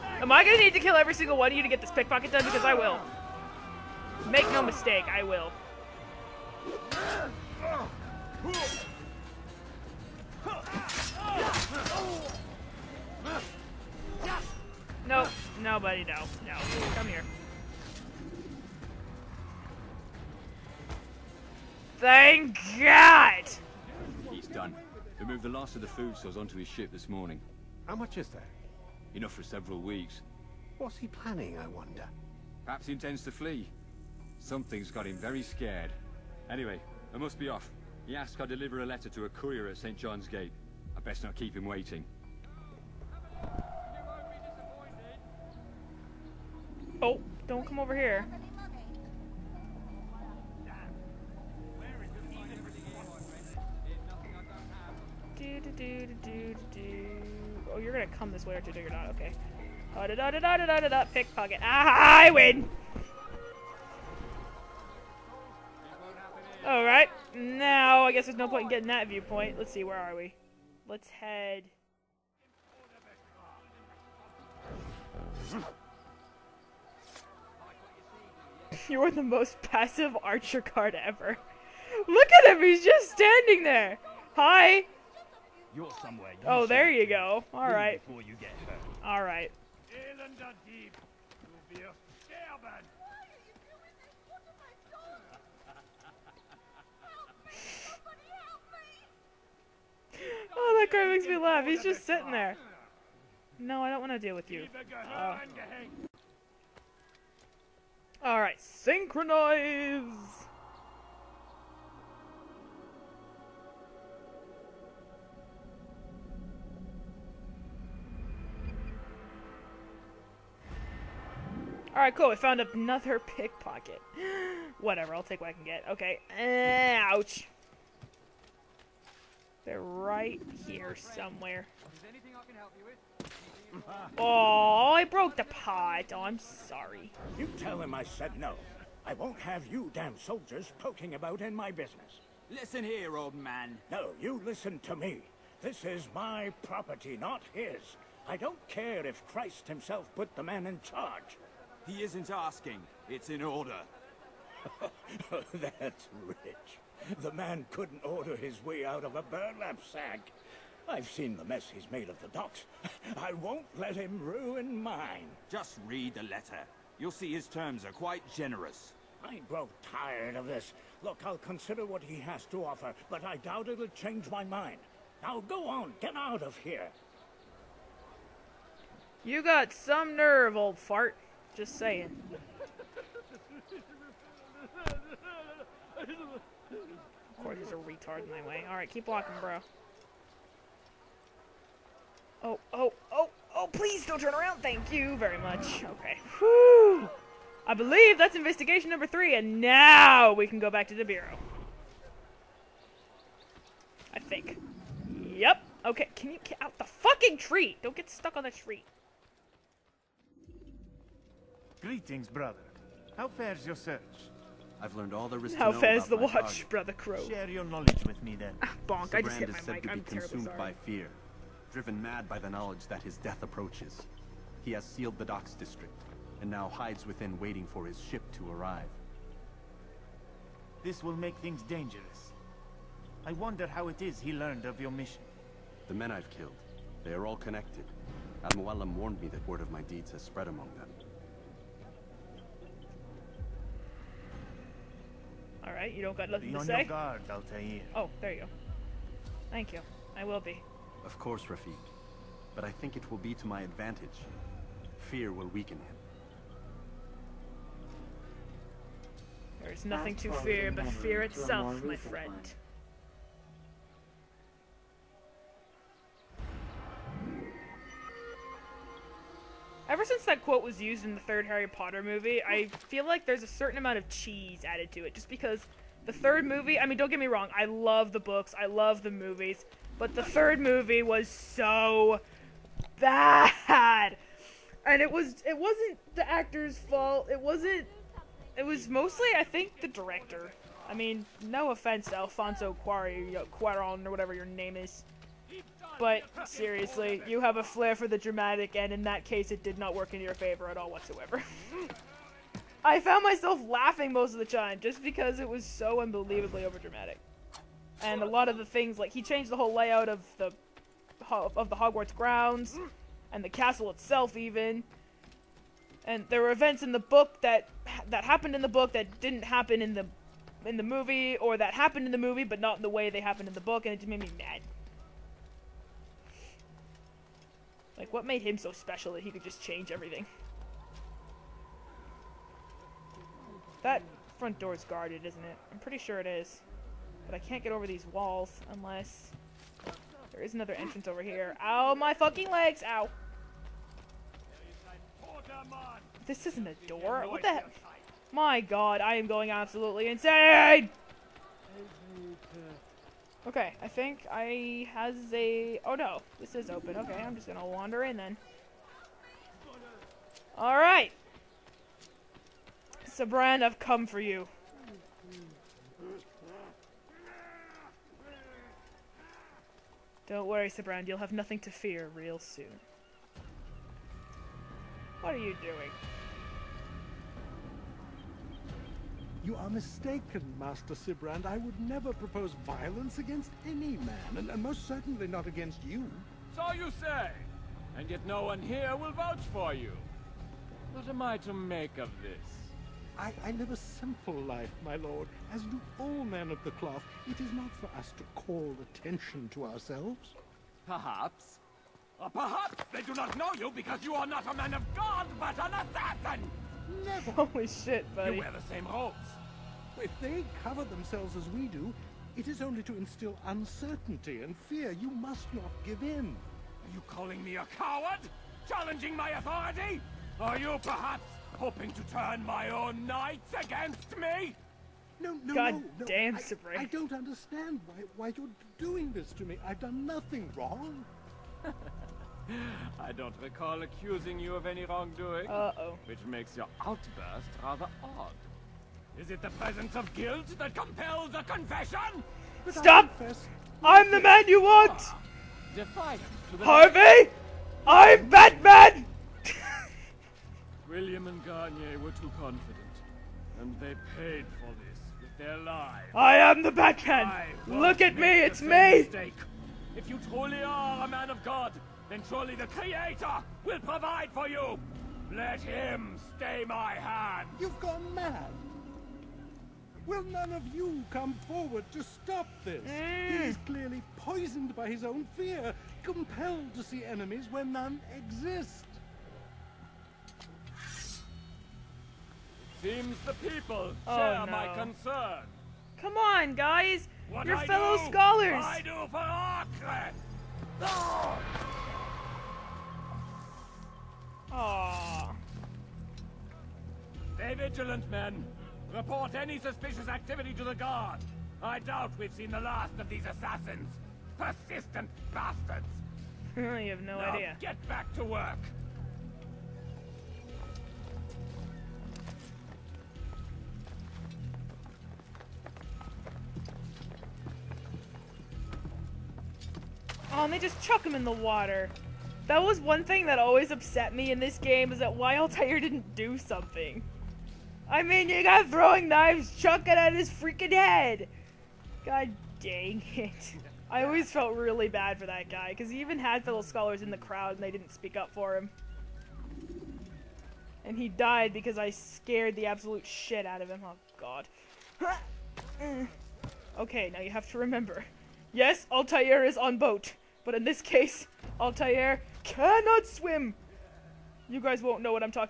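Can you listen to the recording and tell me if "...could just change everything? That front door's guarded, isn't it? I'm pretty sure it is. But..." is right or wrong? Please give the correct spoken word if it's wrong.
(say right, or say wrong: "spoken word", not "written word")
right.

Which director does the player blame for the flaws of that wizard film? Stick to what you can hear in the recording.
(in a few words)
Alfonso Cuaron.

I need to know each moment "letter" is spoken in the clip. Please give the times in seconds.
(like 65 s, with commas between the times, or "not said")
38 s, 166 s.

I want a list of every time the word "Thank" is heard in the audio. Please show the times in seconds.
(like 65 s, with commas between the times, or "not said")
21 s, 194 s, 249 s.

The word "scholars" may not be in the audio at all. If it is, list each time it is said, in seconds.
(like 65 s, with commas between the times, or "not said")
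488 s, 536 s.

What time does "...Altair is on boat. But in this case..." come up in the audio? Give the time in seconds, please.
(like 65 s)
548 s.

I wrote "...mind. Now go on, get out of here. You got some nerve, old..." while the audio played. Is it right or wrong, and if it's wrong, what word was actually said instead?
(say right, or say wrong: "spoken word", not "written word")
right.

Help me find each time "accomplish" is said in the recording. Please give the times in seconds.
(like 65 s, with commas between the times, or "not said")
not said.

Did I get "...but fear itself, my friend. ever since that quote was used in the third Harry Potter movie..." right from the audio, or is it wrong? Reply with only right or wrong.
right.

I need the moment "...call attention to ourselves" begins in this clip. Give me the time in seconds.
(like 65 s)
398 s.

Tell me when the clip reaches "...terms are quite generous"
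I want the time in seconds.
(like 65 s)
167 s.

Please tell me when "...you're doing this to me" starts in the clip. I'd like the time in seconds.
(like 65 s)
428 s.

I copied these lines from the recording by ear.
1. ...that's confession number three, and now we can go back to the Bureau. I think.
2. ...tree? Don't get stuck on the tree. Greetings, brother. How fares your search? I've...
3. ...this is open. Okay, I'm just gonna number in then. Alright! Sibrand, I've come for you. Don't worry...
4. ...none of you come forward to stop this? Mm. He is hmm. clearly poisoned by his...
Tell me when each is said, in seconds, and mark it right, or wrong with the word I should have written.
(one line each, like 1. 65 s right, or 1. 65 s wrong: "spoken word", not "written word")
1. 198 s wrong: "investigation", not "confession"
2. 207 s right
3. 356 s wrong: "wander", not "number"
4. 470 s right.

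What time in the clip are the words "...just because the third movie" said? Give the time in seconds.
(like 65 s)
275 s.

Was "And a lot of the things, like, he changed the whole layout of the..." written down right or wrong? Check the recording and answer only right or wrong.
right.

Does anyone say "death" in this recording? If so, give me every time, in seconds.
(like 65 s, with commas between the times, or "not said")
223 s.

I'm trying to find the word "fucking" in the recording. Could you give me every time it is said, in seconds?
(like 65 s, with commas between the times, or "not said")
206 s, 342 s.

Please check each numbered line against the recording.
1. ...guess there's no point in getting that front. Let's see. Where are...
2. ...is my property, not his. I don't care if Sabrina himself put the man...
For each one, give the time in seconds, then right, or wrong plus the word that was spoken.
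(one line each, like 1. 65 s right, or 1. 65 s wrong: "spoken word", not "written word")
1. 68 s wrong: "viewpoint", not "front"
2. 145 s wrong: "Christ", not "Sabrina".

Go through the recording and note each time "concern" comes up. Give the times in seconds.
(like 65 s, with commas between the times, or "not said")
484 s.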